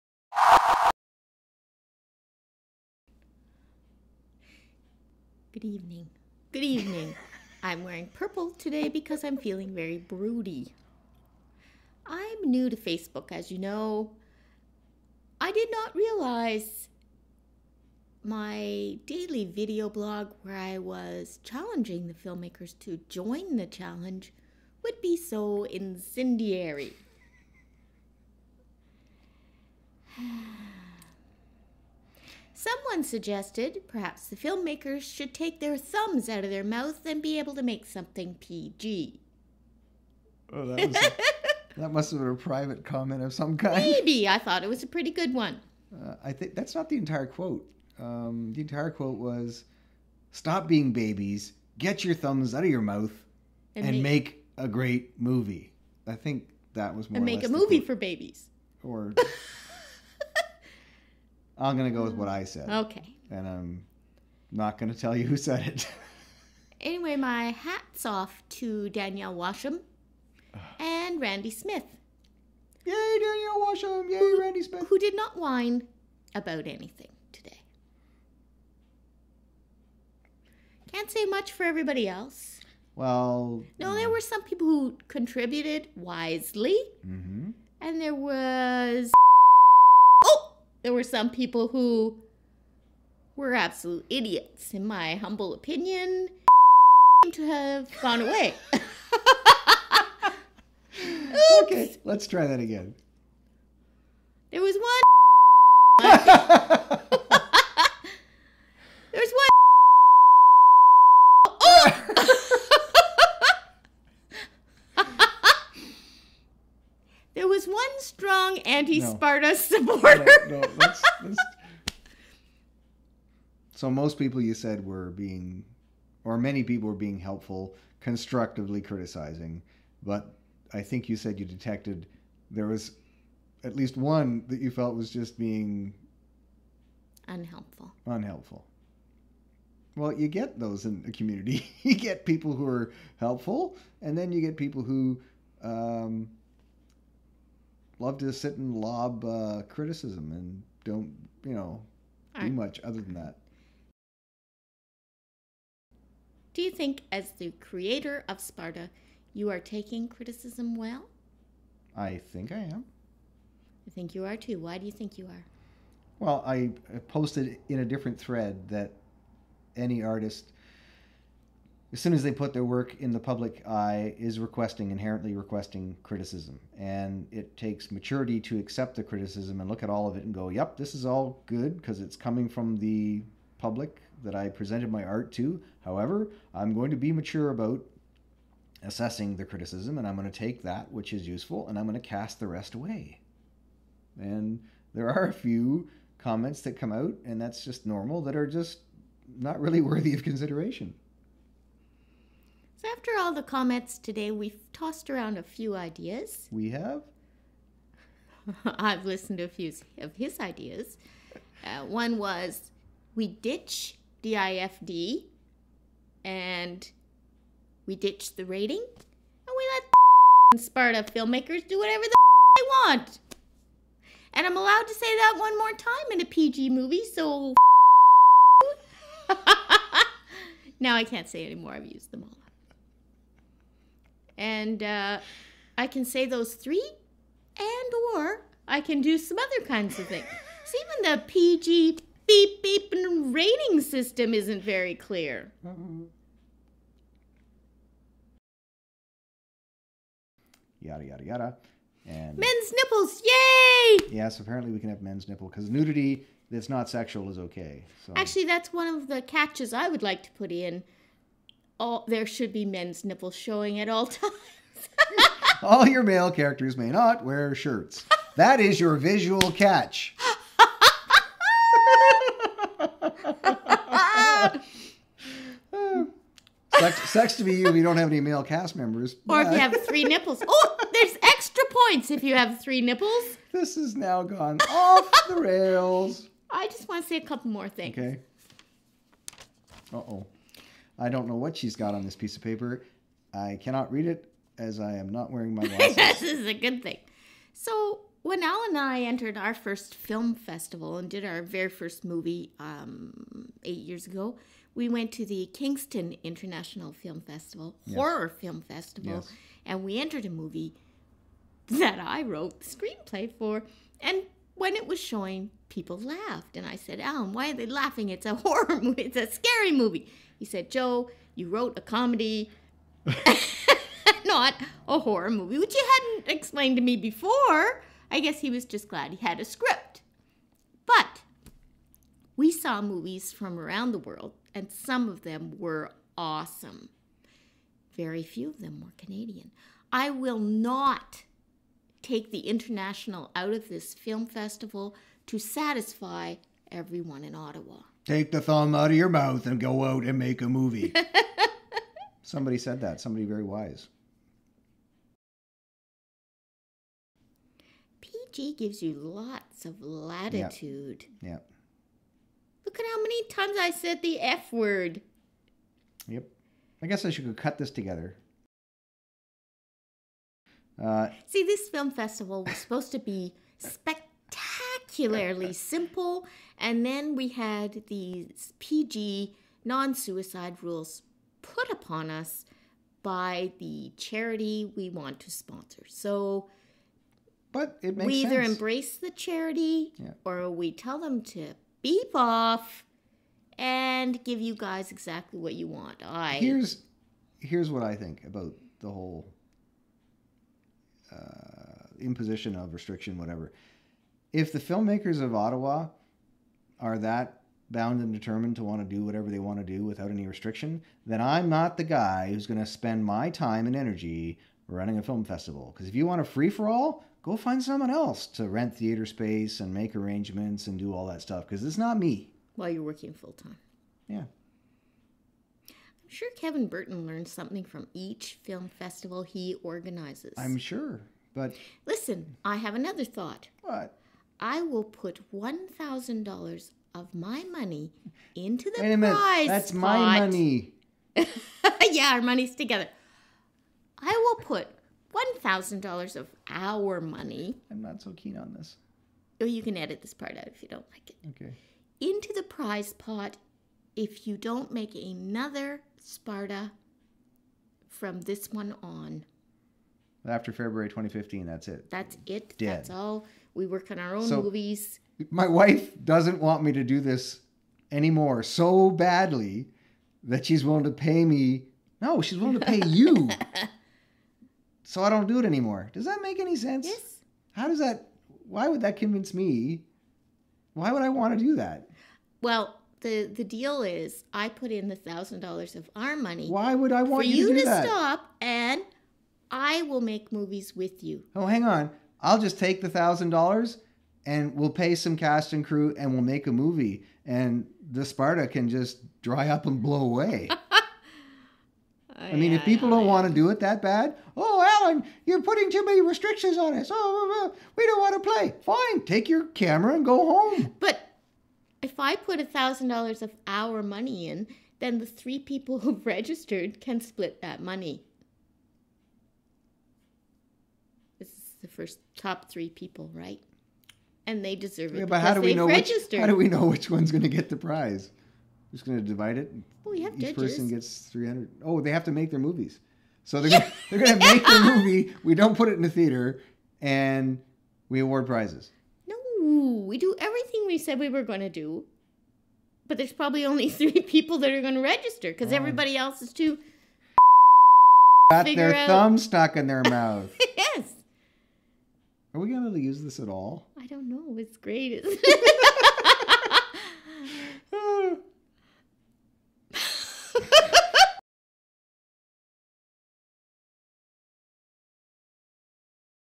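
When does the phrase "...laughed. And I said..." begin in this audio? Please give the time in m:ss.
5:15.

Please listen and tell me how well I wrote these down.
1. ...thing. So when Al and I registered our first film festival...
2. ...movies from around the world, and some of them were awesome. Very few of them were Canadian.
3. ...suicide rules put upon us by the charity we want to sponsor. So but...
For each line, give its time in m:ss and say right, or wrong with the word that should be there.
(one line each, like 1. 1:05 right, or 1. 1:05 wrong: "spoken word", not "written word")
1. 4:56 wrong: "entered", not "registered"
2. 5:32 right
3. 6:19 right.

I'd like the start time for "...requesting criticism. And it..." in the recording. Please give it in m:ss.
2:55.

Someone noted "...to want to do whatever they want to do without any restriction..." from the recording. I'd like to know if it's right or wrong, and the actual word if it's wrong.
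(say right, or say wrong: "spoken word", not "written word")
right.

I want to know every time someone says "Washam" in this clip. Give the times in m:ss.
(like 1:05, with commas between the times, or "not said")
1:09, 1:13.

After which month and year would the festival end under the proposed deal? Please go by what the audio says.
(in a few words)
February 2015.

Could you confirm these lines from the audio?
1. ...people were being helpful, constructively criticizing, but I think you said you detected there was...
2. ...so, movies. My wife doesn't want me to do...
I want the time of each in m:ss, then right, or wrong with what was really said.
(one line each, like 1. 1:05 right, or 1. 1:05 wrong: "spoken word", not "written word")
1. 2:06 right
2. 7:44 right.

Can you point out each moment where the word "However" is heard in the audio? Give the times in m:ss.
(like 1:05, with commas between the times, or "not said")
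3:05.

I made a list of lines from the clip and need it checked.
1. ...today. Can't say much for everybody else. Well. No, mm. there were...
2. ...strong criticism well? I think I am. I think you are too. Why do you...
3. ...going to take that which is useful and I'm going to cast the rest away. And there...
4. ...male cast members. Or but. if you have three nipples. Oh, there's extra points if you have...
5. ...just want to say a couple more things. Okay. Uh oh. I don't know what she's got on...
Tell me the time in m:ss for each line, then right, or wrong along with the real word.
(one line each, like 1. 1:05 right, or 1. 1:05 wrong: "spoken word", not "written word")
1. 1:17 right
2. 2:39 wrong: "taking", not "strong"
3. 3:10 right
4. 4:38 right
5. 4:46 right.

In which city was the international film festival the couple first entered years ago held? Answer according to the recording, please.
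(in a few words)
Kingston.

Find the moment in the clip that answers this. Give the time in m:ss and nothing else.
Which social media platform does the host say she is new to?
0:12.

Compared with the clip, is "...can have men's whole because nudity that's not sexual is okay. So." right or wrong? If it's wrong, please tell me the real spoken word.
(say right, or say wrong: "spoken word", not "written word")
wrong: "nipple", not "whole".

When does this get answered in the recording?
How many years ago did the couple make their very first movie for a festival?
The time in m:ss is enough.
5:03.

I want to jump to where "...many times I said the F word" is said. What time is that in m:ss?
6:03.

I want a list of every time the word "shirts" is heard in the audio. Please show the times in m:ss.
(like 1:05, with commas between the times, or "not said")
4:27.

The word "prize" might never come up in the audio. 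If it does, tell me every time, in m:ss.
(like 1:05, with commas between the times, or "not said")
7:19, 7:32, 8:47, 8:58.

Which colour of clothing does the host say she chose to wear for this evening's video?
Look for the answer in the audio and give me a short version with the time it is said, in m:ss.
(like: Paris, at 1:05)
purple, at 0:08.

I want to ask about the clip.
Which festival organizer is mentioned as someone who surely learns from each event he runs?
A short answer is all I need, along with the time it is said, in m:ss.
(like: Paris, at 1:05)
Kevin Burton, at 7:06.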